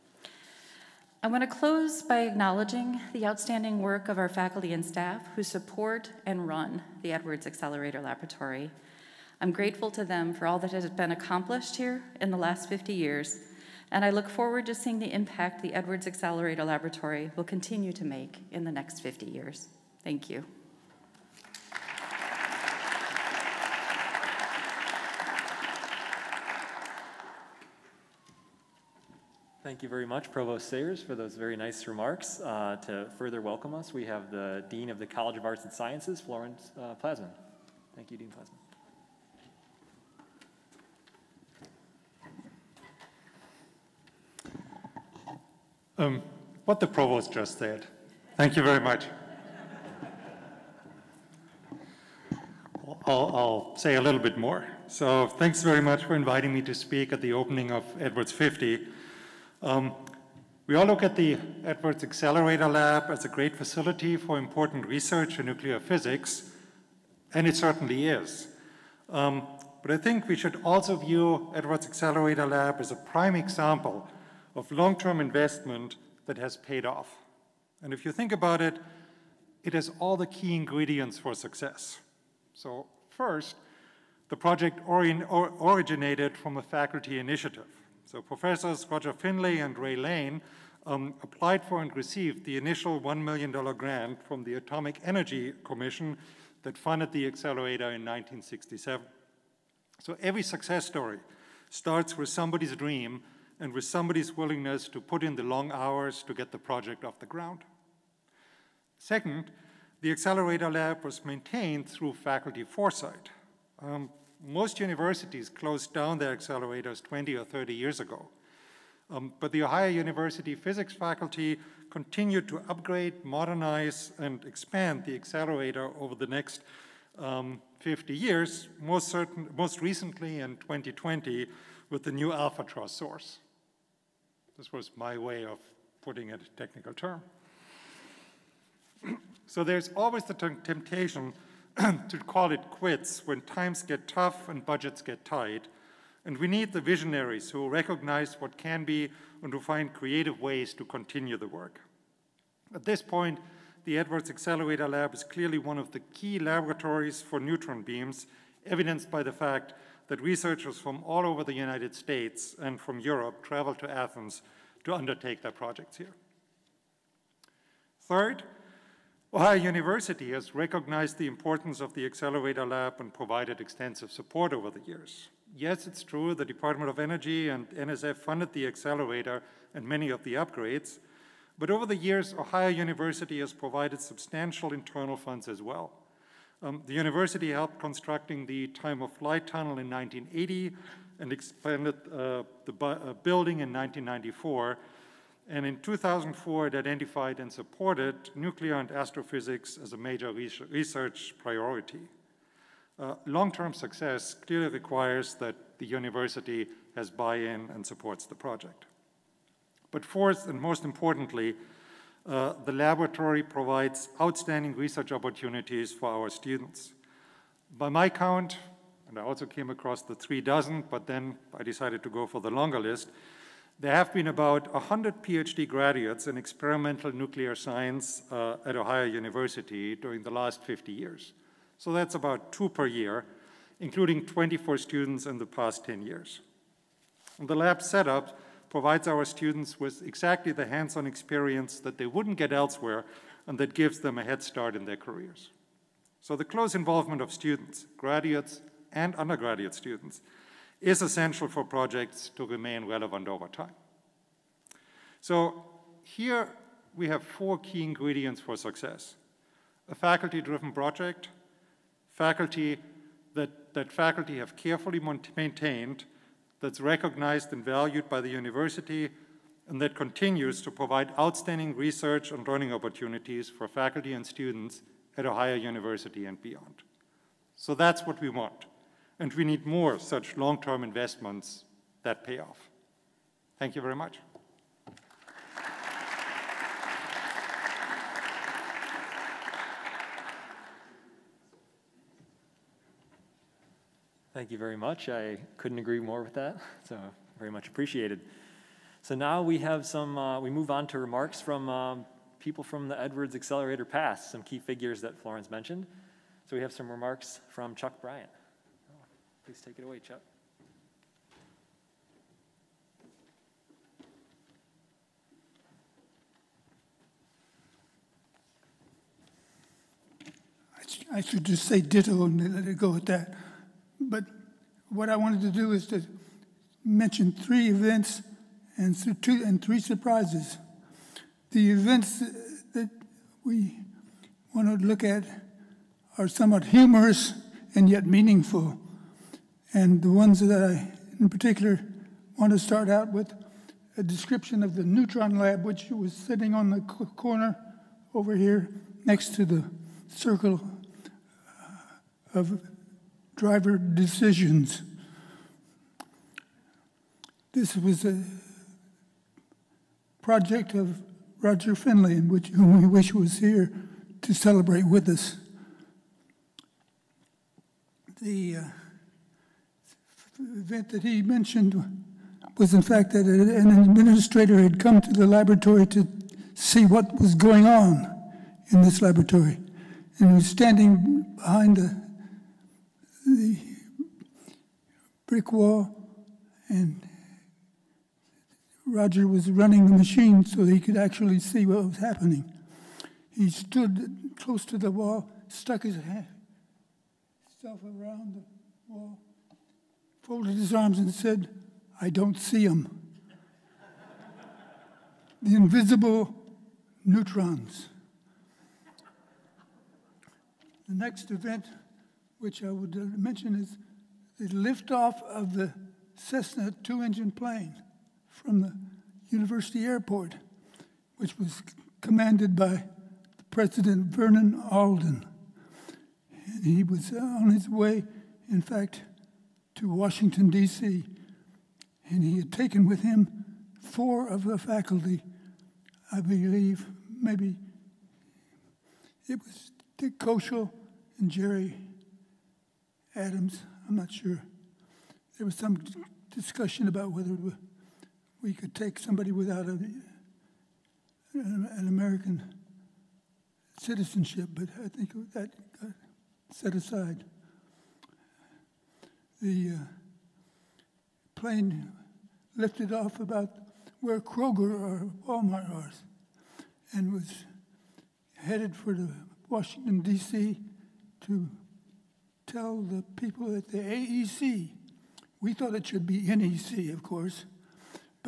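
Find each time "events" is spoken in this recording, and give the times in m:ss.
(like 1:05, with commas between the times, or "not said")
5:27, 5:31, 6:10, 6:51.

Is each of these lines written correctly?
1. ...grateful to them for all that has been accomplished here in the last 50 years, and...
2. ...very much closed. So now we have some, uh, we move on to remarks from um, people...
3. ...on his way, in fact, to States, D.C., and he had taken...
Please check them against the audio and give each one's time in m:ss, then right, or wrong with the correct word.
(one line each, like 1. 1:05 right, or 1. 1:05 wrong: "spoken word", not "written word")
1. 0:09 right
2. 4:57 wrong: "appreciated", not "closed"
3. 7:07 wrong: "Washington", not "States".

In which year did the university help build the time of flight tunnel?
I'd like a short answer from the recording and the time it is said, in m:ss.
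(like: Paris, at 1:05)
1980, at 3:09.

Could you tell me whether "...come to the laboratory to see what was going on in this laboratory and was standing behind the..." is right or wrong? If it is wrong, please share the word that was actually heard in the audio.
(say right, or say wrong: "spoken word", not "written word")
right.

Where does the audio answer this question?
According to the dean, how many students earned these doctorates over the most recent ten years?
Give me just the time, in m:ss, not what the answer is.
3:54.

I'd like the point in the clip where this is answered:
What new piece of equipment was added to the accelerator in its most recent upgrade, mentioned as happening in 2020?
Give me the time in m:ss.
2:12.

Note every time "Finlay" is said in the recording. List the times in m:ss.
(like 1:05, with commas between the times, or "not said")
1:29, 6:01.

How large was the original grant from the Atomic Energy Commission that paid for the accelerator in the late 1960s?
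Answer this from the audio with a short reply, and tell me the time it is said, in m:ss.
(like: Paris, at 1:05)
$1 million, at 1:32.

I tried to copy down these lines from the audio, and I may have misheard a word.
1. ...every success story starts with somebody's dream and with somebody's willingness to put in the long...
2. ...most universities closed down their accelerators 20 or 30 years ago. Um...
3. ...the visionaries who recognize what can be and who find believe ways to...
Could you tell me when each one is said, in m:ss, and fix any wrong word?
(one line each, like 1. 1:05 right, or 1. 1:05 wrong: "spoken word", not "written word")
1. 1:40 right
2. 1:54 right
3. 2:26 wrong: "creative", not "believe".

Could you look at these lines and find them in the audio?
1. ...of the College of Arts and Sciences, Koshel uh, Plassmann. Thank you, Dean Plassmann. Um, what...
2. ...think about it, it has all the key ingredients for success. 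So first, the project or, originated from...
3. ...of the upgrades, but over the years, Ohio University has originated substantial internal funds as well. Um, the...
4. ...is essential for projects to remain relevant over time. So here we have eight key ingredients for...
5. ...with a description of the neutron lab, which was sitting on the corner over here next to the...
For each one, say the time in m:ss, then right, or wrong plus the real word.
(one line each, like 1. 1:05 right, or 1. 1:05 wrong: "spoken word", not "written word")
1. 0:34 wrong: "Florenz", not "Koshel"
2. 1:18 right
3. 3:00 wrong: "provided", not "originated"
4. 4:10 wrong: "four", not "eight"
5. 5:43 right.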